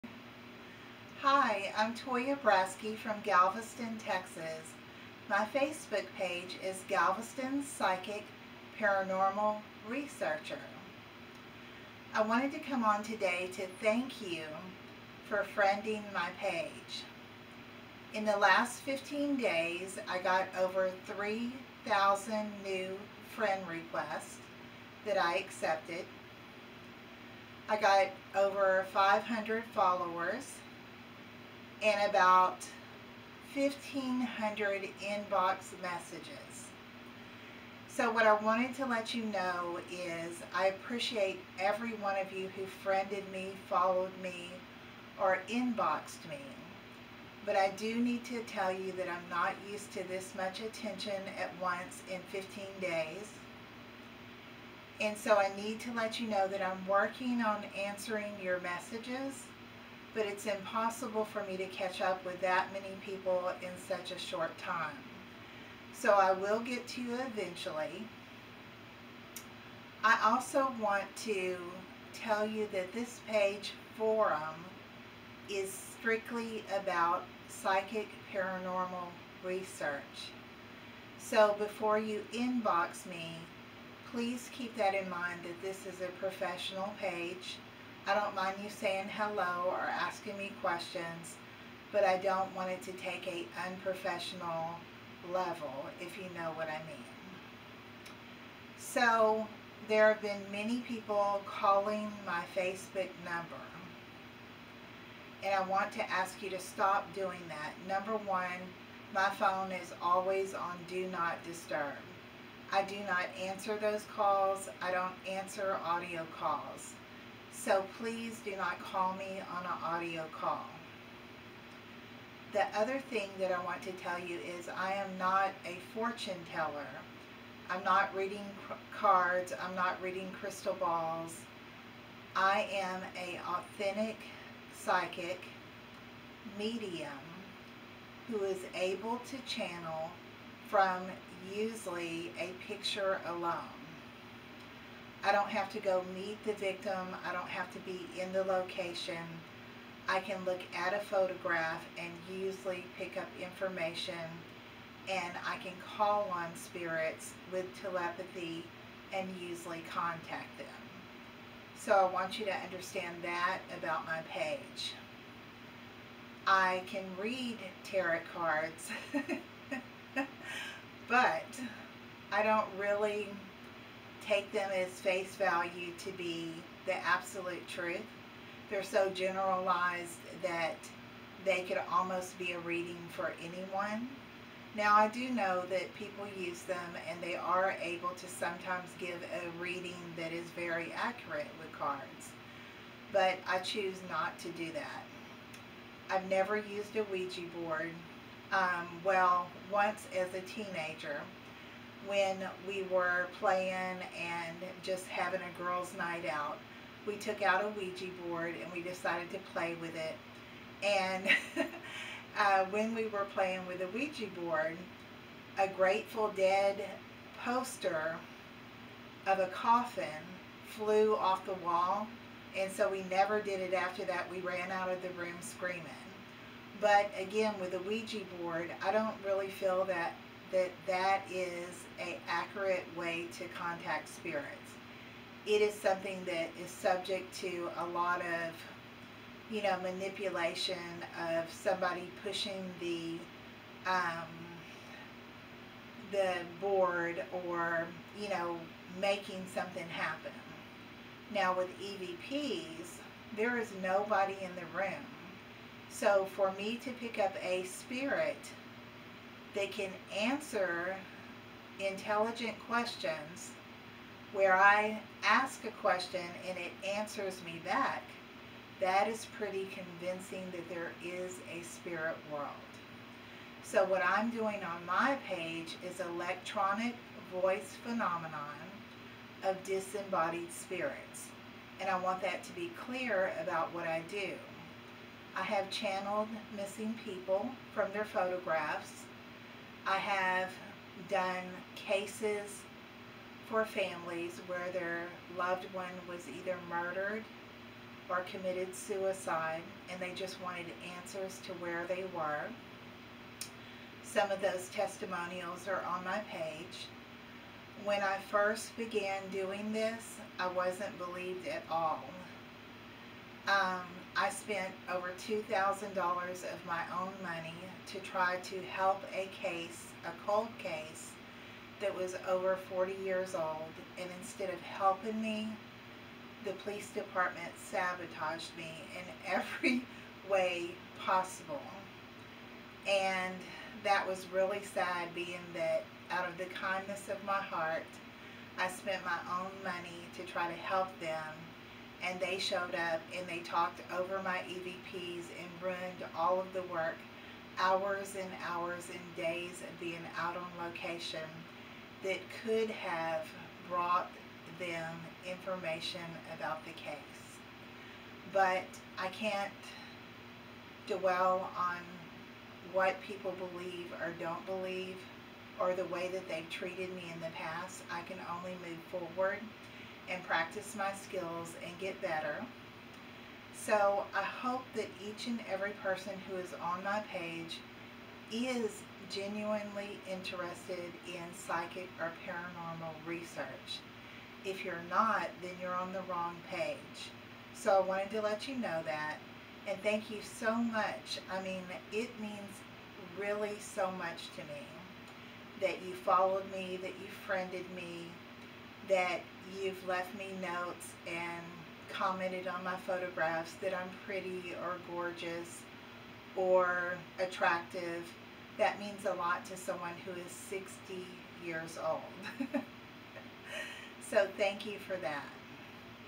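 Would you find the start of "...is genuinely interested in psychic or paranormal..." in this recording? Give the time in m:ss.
6:18.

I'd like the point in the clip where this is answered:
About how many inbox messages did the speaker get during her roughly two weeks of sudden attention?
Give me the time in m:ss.
0:33.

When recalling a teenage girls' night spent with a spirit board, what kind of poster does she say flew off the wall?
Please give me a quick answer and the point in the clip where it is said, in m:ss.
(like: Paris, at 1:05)
Grateful Dead, at 3:35.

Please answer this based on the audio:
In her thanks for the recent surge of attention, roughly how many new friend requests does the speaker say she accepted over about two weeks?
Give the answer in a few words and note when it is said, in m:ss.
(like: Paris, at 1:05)
3,000, at 0:21.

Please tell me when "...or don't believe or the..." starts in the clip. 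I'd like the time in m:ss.
6:04.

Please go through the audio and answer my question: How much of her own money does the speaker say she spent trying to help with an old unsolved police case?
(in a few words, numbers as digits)
$2,000.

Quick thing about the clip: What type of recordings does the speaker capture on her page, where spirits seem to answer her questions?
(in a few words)
electronic voice phenomenon.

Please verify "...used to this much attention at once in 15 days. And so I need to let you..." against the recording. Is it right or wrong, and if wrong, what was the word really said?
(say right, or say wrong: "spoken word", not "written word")
right.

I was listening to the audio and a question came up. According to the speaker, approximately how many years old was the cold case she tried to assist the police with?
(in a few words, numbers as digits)
40 years.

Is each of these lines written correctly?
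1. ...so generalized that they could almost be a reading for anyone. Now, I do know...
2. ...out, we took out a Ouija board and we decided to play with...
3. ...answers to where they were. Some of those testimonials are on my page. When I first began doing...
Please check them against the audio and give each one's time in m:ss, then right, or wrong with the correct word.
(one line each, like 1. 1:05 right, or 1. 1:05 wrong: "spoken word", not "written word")
1. 2:58 right
2. 3:26 right
3. 5:00 right.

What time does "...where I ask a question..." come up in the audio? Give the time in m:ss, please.
4:24.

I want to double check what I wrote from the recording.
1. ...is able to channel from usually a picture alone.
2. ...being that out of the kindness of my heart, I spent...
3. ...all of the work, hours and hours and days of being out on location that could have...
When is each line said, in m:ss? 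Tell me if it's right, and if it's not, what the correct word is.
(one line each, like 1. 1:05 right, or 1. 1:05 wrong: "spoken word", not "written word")
1. 2:18 right
2. 5:35 right
3. 5:46 right.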